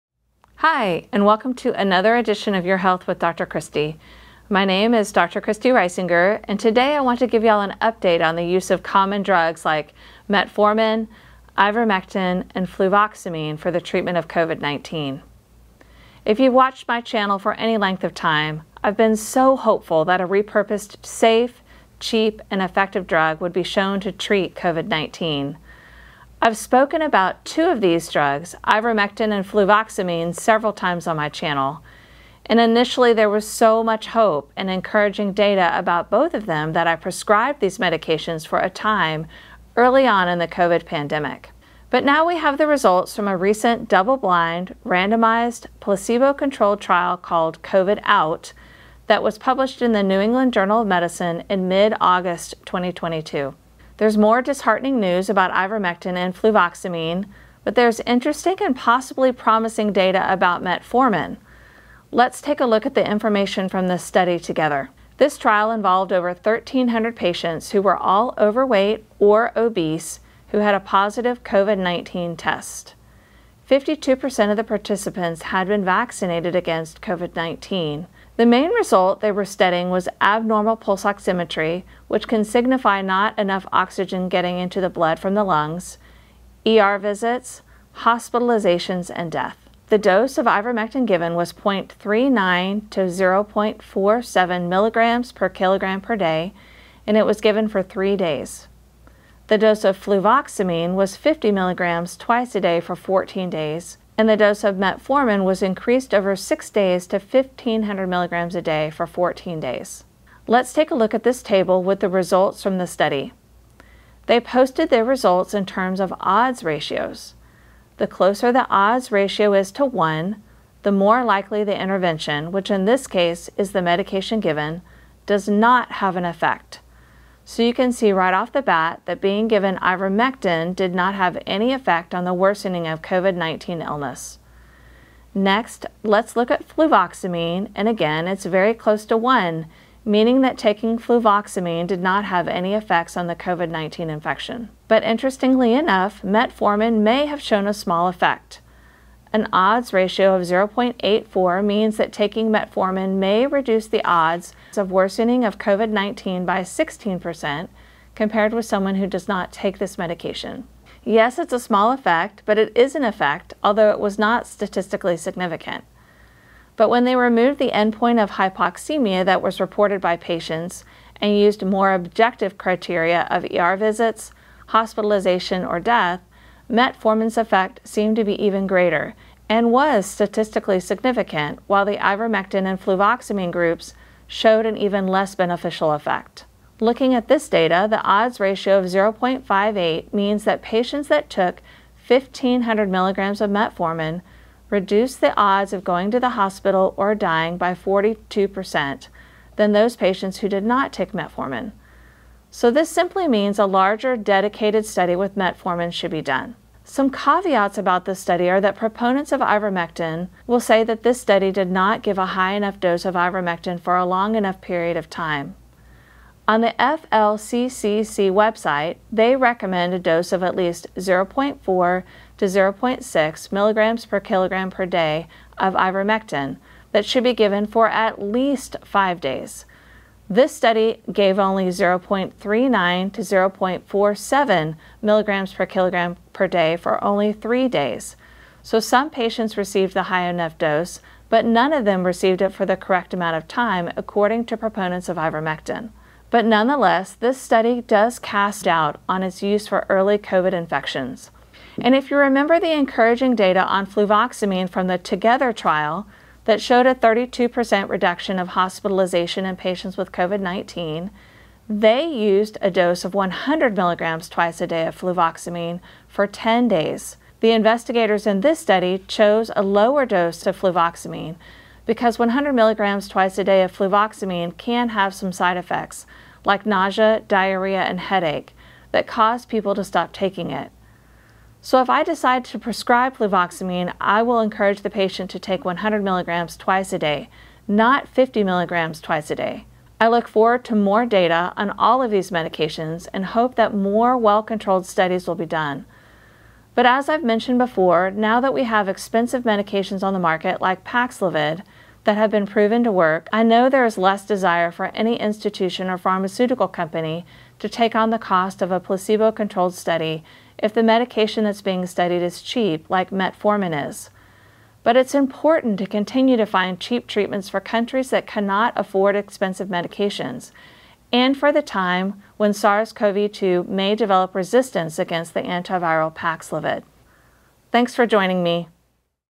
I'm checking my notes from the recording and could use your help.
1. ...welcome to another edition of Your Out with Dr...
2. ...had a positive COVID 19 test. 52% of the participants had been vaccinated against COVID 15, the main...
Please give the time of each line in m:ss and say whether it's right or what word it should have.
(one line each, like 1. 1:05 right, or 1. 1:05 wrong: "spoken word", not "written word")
1. 0:01 wrong: "Health", not "Out"
2. 1:10 wrong: "19", not "15".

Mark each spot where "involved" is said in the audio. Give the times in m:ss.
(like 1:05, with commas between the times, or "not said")
1:05.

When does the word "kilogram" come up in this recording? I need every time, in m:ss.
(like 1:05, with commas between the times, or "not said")
1:35, 3:44, 3:55.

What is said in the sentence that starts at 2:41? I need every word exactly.
Yes, it's a small effect, but it is an effect, although it was not statistically significant.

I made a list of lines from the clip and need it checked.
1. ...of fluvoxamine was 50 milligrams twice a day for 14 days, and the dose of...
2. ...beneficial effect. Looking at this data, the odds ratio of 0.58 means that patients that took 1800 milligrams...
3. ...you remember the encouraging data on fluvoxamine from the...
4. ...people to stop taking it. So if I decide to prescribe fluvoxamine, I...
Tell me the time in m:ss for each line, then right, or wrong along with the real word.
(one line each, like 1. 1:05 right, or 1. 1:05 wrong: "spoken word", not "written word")
1. 1:39 right
2. 3:05 wrong: "1500", not "1800"
3. 4:12 right
4. 4:39 right.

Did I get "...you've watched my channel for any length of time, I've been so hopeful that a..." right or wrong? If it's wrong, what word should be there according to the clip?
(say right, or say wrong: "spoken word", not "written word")
right.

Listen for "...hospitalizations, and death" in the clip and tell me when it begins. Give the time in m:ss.
1:27.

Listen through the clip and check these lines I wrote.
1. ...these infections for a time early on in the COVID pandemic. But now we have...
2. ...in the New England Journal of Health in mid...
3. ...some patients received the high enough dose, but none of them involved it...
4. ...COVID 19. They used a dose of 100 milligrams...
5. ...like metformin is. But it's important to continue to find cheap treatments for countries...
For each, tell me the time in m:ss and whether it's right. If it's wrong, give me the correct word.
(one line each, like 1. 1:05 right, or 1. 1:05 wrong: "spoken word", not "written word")
1. 0:37 wrong: "medications", not "infections"
2. 0:49 wrong: "Medicine", not "Health"
3. 3:58 wrong: "received", not "involved"
4. 4:20 right
5. 5:12 right.